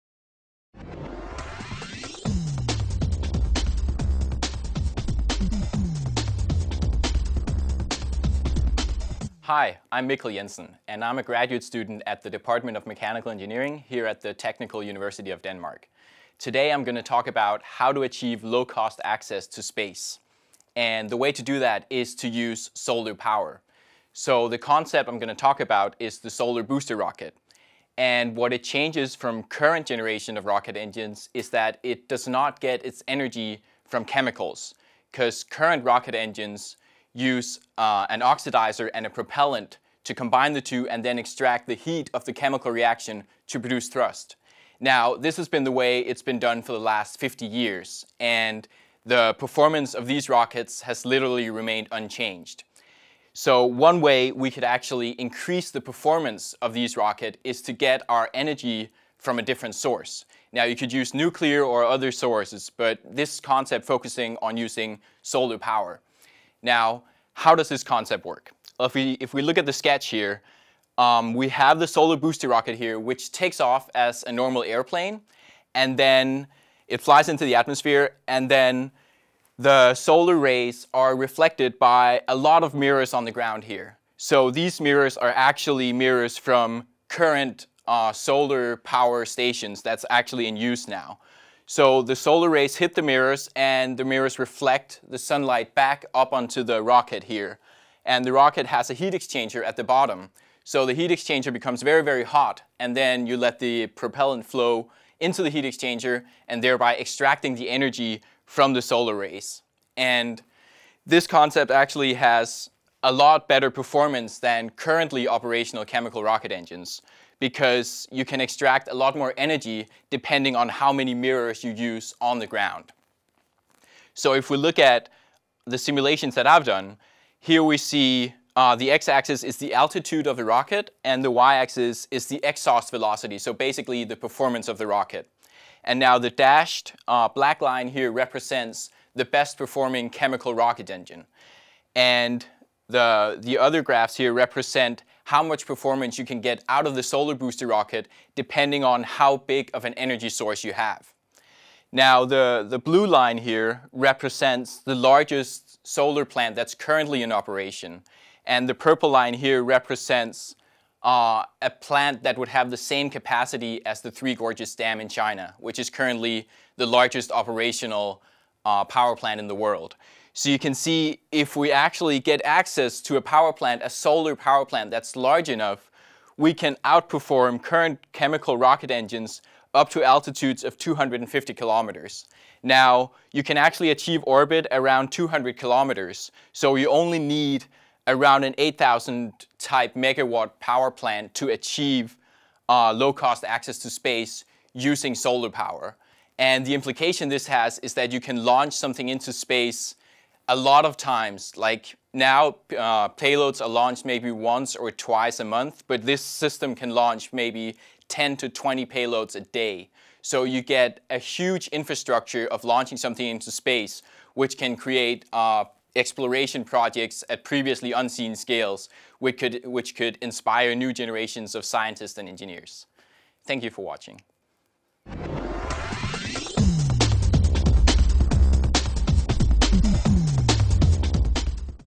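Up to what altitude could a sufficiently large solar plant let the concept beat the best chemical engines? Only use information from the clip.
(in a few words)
250 kilometers.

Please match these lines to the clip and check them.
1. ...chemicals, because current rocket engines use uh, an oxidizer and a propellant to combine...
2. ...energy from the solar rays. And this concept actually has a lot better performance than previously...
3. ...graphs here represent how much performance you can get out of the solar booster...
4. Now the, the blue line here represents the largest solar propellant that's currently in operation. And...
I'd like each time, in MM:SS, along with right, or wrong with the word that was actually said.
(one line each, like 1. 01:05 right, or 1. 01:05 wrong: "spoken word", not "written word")
1. 00:34 right
2. 01:47 wrong: "currently", not "previously"
3. 02:23 right
4. 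02:31 wrong: "plant", not "propellant".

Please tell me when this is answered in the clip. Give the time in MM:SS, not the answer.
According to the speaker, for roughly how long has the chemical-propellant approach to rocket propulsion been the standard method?
00:47.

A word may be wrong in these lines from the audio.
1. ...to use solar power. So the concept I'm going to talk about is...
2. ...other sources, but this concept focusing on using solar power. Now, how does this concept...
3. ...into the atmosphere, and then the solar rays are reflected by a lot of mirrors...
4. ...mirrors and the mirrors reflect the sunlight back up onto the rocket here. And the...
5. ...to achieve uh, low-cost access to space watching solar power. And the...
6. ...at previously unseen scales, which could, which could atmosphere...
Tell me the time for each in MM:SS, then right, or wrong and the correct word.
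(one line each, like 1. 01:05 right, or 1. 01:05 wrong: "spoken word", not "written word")
1. 00:22 right
2. 01:01 right
3. 01:17 right
4. 01:33 right
5. 03:11 wrong: "using", not "watching"
6. 03:37 wrong: "inspire", not "atmosphere".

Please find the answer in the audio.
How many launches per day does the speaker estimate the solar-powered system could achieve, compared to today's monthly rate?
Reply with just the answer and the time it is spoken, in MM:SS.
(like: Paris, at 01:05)
10 to 20, at 03:28.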